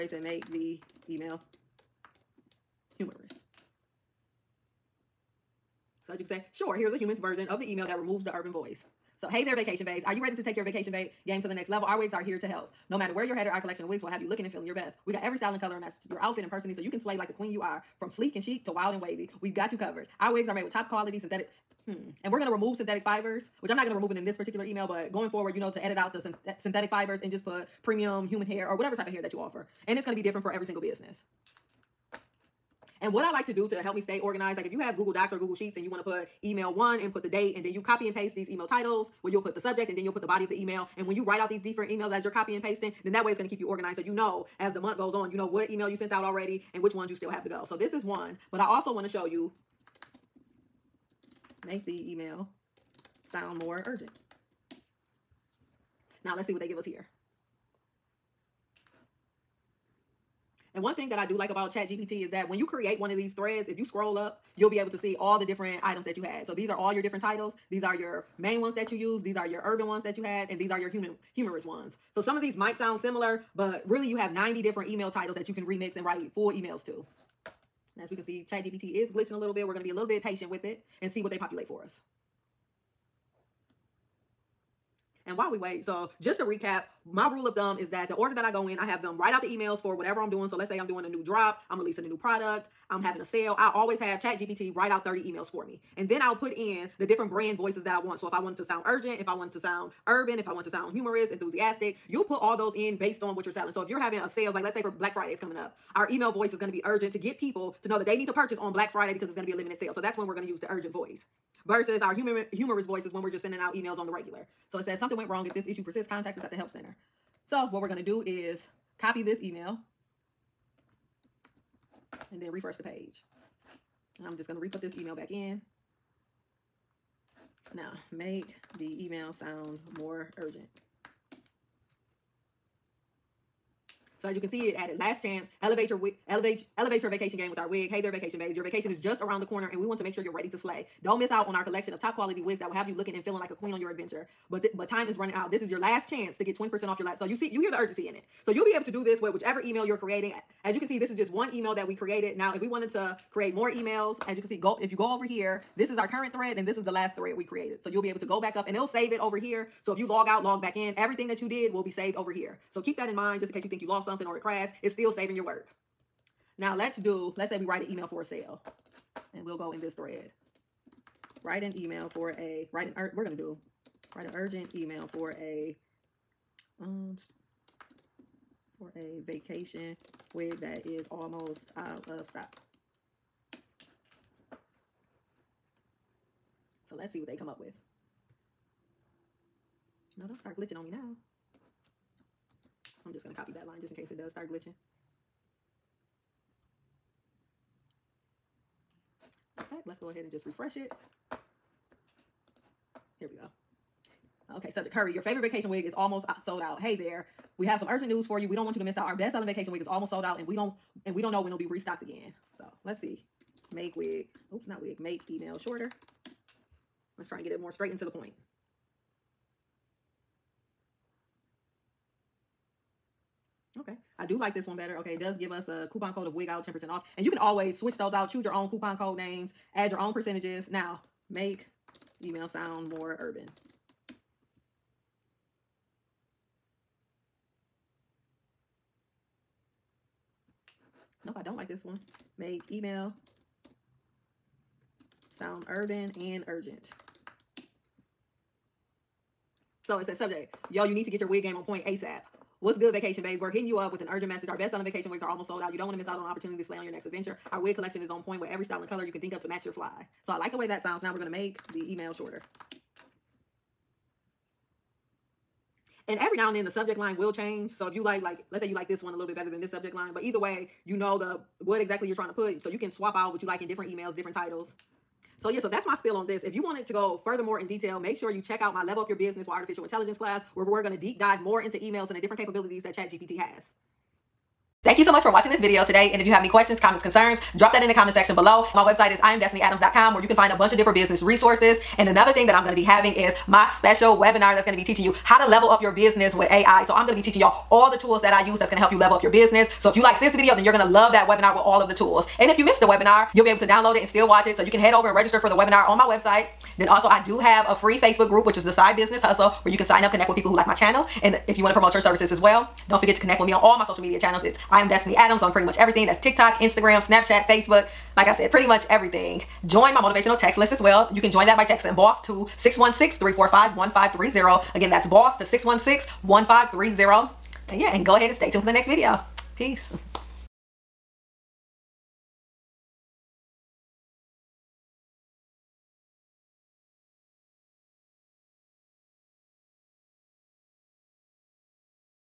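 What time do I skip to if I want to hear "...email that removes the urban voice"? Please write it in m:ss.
0:07.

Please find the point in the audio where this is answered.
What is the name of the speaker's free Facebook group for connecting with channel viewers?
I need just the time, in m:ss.
5:08.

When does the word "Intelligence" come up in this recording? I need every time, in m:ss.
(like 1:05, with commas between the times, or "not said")
4:39.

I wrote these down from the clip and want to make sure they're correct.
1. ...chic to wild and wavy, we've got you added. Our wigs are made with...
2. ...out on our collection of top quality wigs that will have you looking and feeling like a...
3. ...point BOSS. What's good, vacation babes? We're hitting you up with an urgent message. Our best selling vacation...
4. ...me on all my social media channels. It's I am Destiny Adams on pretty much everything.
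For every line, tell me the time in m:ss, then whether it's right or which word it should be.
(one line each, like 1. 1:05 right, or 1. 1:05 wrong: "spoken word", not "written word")
1. 0:18 wrong: "covered", not "added"
2. 2:21 right
3. 4:11 wrong: "ASAP", not "BOSS"
4. 5:13 right.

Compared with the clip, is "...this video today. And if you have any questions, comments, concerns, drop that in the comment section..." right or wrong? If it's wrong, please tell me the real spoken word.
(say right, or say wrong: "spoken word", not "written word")
right.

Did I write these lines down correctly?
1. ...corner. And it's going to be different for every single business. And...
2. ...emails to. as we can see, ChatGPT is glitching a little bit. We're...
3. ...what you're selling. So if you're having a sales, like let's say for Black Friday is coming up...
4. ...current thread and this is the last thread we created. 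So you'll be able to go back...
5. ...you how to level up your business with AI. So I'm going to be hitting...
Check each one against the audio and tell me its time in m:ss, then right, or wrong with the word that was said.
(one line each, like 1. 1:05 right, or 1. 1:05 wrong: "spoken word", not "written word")
1. 0:29 wrong: "offer", not "corner"
2. 1:16 right
3. 1:43 right
4. 2:36 right
5. 4:55 wrong: "teaching", not "hitting".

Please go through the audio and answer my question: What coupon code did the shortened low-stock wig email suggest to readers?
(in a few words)
wig out.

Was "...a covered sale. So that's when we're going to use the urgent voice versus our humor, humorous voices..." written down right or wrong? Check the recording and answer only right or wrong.
wrong.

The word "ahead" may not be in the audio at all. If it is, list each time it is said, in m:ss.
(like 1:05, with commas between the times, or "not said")
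3:20, 5:28.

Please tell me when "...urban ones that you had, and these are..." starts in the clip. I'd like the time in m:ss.
1:09.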